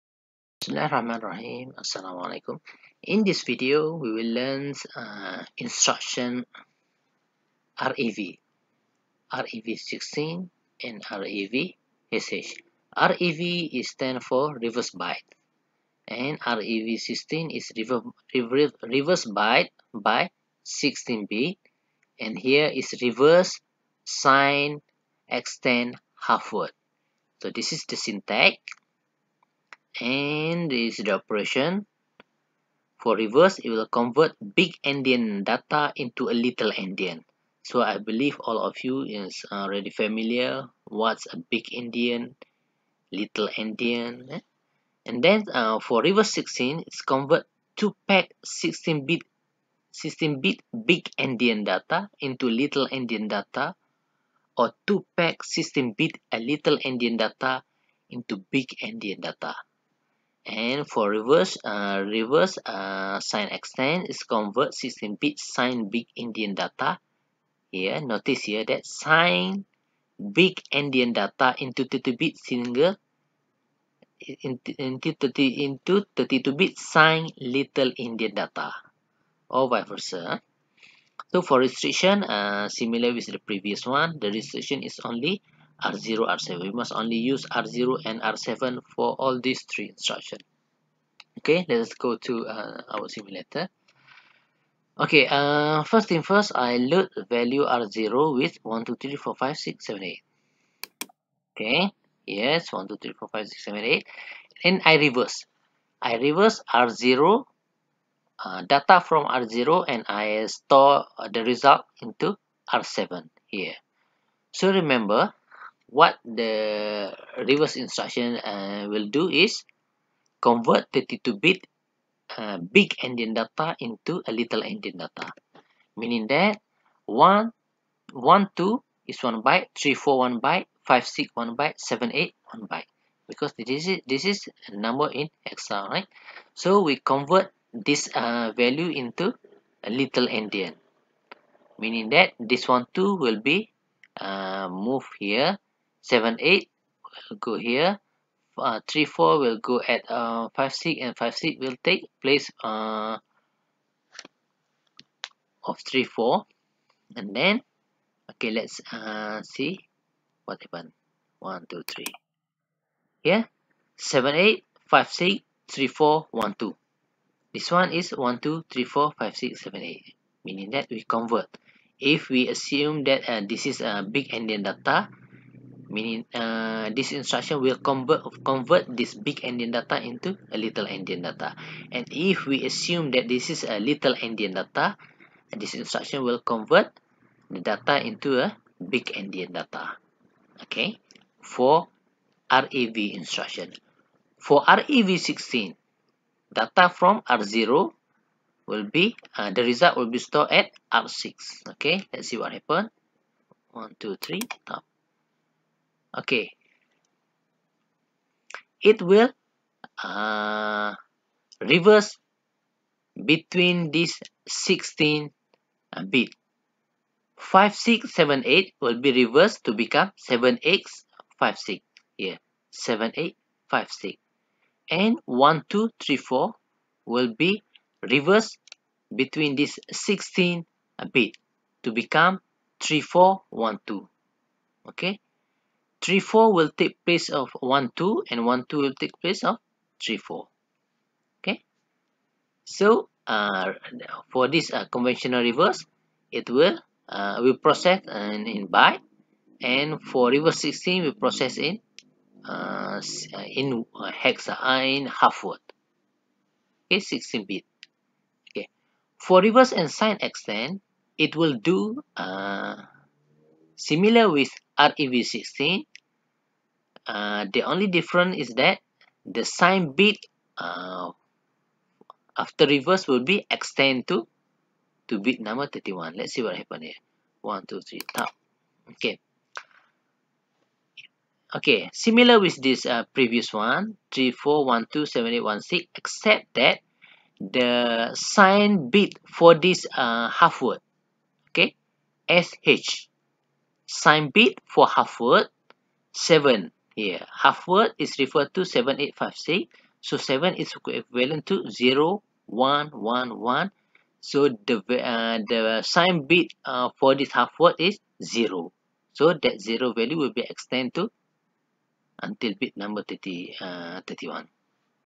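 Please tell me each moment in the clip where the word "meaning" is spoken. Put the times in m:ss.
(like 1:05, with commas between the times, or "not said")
2:05, 2:21, 2:50, 2:55.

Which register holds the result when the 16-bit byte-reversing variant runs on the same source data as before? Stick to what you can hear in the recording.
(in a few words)
R6.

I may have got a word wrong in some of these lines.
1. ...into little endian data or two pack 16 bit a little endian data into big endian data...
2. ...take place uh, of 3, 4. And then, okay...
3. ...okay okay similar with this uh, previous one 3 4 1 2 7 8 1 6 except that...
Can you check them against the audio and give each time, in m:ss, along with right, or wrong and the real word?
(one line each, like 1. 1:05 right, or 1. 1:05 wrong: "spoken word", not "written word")
1. 0:52 right
2. 2:31 right
3. 4:38 right.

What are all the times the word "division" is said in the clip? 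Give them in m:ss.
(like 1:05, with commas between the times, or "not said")
not said.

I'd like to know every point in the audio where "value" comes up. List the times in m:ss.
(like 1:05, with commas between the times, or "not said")
1:37, 2:18, 5:09.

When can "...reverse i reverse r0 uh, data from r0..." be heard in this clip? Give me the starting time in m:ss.
1:44.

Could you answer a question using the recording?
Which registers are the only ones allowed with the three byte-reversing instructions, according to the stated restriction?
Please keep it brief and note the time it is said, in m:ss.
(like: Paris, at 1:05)
R0 to R7, at 1:25.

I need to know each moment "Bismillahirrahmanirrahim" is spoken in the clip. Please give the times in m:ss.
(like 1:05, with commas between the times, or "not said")
0:00.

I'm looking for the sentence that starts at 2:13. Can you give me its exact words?
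Because this is, this is a number in hexa, right?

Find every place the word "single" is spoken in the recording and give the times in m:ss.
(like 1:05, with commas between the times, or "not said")
1:12.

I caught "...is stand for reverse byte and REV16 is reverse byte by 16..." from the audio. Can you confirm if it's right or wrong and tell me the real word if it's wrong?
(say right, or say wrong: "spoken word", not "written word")
right.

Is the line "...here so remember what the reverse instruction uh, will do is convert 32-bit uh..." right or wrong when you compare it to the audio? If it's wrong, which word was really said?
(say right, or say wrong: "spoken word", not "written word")
right.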